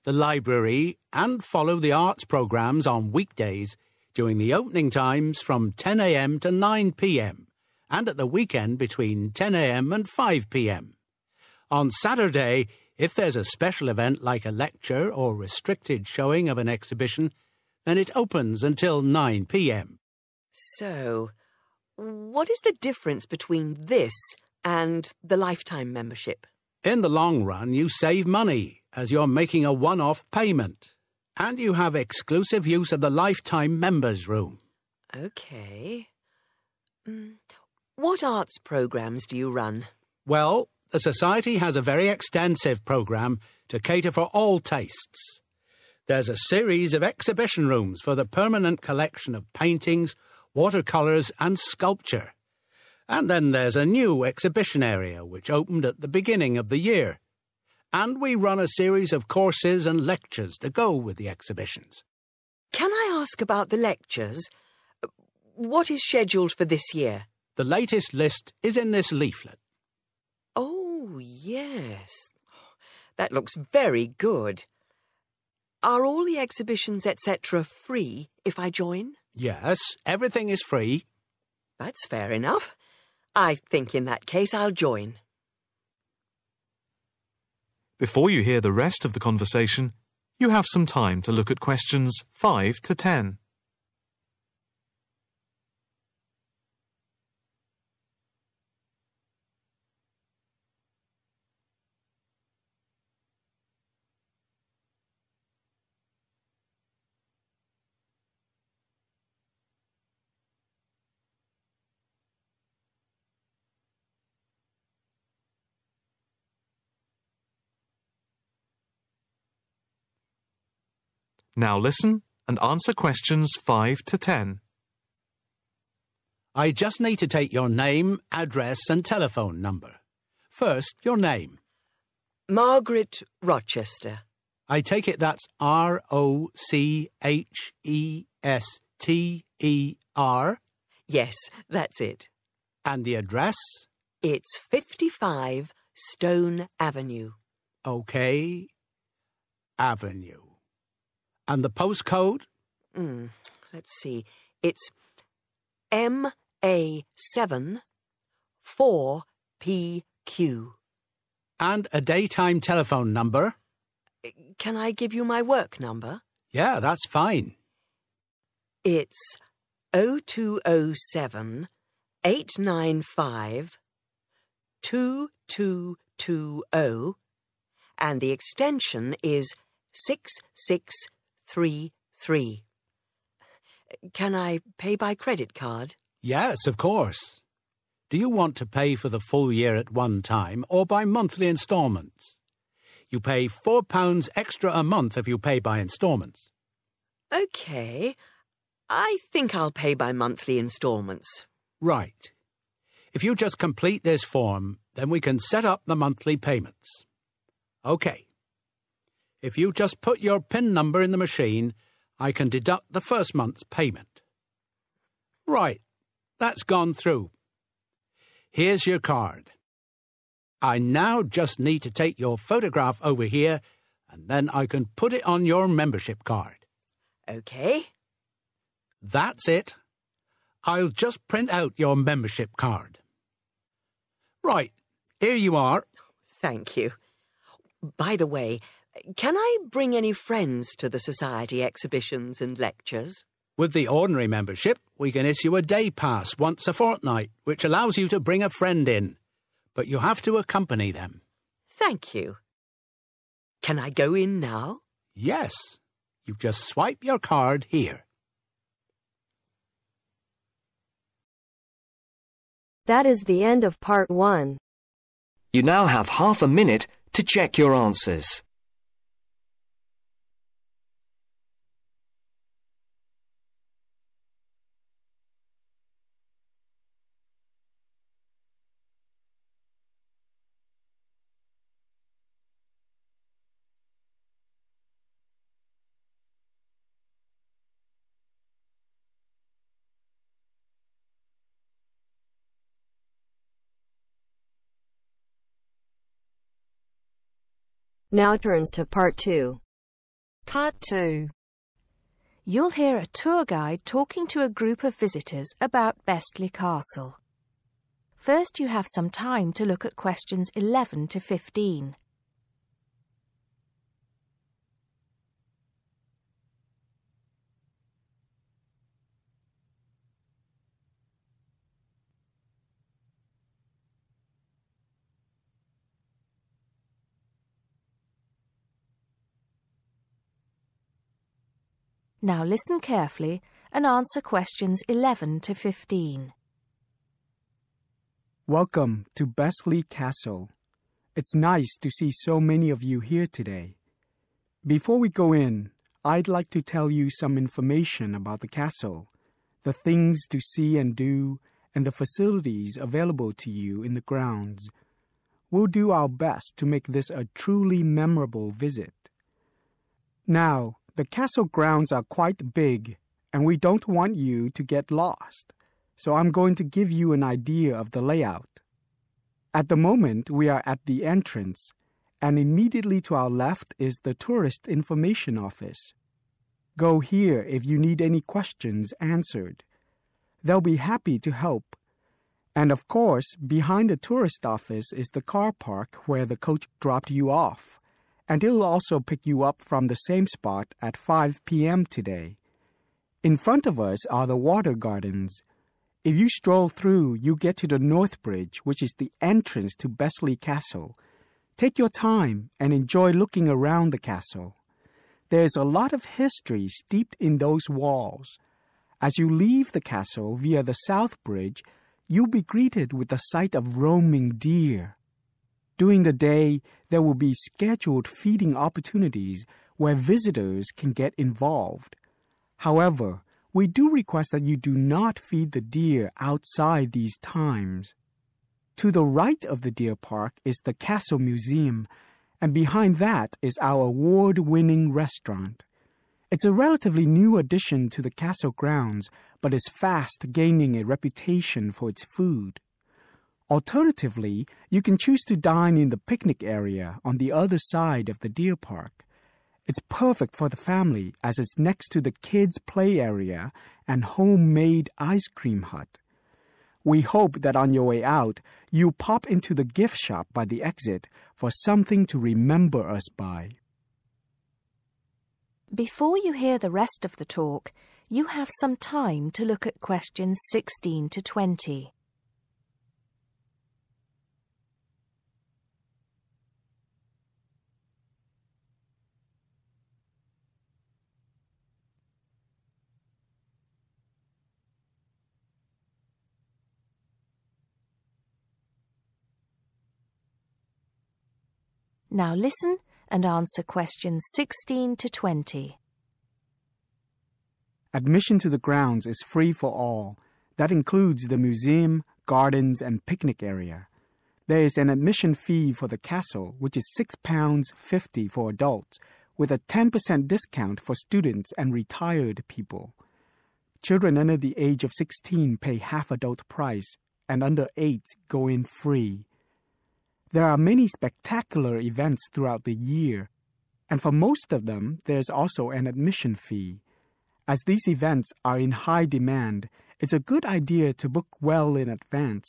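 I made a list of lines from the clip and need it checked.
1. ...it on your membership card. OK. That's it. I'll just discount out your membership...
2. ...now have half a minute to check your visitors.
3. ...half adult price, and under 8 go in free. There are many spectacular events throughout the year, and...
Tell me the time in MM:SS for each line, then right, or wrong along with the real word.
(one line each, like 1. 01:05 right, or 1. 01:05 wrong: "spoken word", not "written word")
1. 03:45 wrong: "print", not "discount"
2. 04:25 wrong: "answers", not "visitors"
3. 08:35 right.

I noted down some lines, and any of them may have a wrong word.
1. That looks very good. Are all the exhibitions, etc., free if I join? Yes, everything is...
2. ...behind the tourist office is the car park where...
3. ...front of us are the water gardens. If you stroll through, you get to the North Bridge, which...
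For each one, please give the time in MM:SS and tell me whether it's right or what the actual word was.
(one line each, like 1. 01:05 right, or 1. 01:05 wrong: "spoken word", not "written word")
1. 01:13 right
2. 06:23 right
3. 06:33 right.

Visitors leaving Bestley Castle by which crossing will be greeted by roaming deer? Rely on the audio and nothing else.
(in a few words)
South Bridge.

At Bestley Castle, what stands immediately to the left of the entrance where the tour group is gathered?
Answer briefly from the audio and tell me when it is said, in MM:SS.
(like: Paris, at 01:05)
Tourist Information Office, at 06:14.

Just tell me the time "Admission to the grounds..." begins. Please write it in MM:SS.
08:17.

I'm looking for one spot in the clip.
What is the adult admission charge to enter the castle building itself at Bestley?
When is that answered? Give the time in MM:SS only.
08:26.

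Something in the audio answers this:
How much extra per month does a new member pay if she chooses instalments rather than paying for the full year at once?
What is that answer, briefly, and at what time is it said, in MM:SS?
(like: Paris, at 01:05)
£4, at 03:13.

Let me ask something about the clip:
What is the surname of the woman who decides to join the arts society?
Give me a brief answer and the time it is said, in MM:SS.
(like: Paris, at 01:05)
Rochester, at 02:12.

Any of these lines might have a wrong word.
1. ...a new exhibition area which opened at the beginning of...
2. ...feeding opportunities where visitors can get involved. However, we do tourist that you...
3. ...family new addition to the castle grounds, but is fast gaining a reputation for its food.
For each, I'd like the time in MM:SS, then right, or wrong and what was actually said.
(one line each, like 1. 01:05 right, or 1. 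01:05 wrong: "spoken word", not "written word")
1. 00:53 right
2. 06:58 wrong: "request", not "tourist"
3. 07:16 wrong: "relatively", not "family".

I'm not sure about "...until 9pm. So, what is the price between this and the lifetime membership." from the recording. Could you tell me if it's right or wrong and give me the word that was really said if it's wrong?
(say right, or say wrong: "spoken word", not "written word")
wrong: "difference", not "price".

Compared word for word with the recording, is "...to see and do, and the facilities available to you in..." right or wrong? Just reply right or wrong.
right.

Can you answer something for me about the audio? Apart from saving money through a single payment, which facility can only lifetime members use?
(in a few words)
lifetime members room.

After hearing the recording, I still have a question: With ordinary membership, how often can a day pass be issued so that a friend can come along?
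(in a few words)
once a fortnight.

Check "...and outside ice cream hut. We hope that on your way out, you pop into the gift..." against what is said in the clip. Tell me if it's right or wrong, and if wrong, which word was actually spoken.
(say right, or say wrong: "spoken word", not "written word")
wrong: "homemade", not "outside".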